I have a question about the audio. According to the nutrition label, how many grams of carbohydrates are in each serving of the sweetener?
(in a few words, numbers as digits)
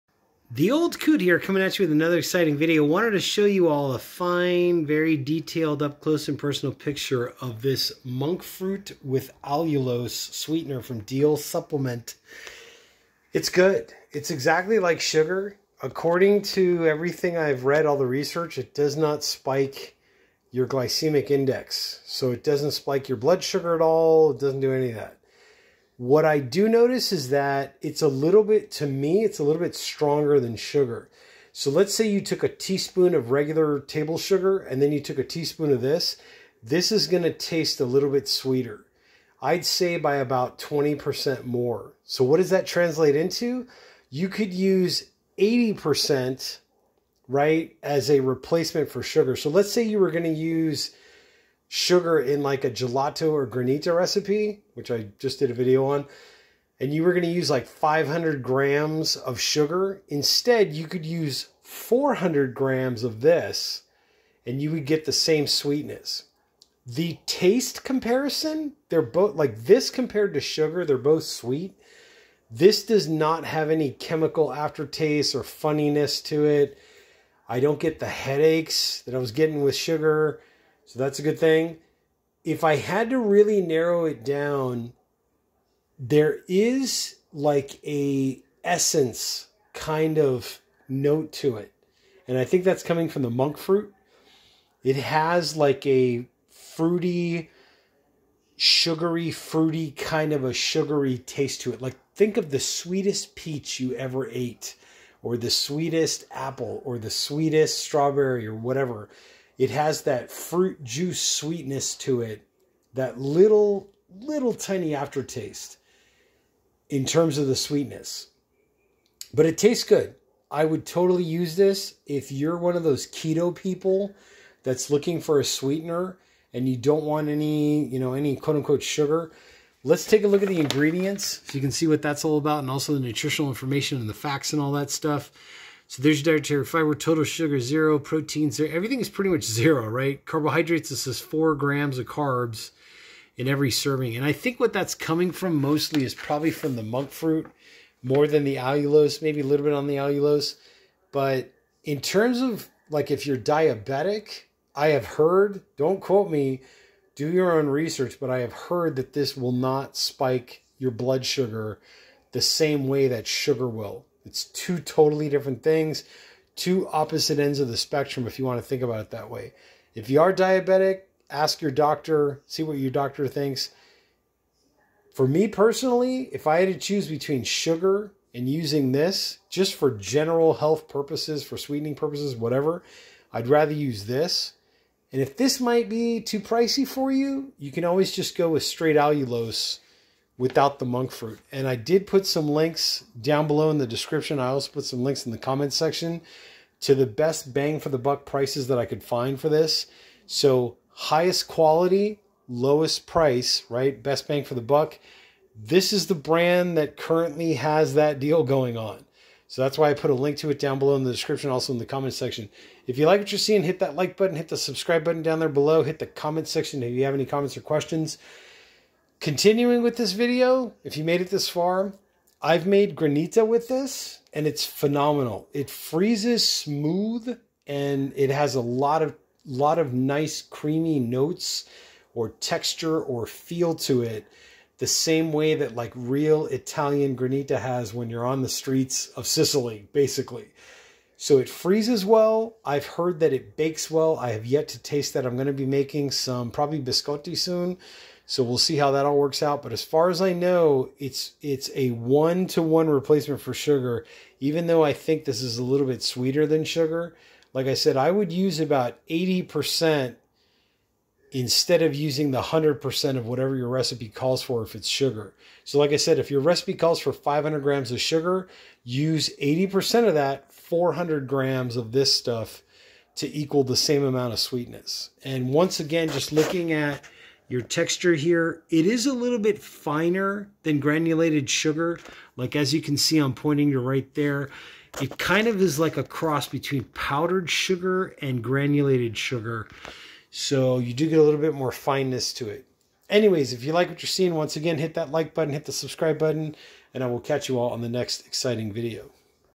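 4 grams.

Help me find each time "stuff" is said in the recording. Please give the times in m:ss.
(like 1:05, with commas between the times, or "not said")
2:14, 4:32.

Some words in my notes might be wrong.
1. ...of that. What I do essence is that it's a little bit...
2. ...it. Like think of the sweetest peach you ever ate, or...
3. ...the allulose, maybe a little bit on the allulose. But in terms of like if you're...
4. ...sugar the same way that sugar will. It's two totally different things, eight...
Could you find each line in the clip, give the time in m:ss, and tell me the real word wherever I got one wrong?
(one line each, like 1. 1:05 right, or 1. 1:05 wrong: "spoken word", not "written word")
1. 0:24 wrong: "notice", not "essence"
2. 1:41 right
3. 2:28 right
4. 2:41 wrong: "two", not "eight".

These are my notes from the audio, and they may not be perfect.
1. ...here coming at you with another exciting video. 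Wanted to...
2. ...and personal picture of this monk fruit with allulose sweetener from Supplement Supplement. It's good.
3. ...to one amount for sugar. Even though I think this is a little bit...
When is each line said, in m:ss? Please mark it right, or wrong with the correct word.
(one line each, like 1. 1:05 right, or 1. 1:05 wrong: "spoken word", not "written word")
1. 0:01 right
2. 0:06 wrong: "Deal", not "Supplement"
3. 4:12 wrong: "replacement", not "amount".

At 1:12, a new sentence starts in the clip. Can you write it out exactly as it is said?
This does not have any chemical aftertaste or funniness to it.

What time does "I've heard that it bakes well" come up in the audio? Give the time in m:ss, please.
4:02.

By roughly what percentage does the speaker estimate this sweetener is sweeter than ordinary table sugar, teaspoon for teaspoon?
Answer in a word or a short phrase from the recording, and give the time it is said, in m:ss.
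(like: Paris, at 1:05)
20%, at 0:40.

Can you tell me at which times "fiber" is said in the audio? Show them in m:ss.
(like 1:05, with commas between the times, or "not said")
2:16.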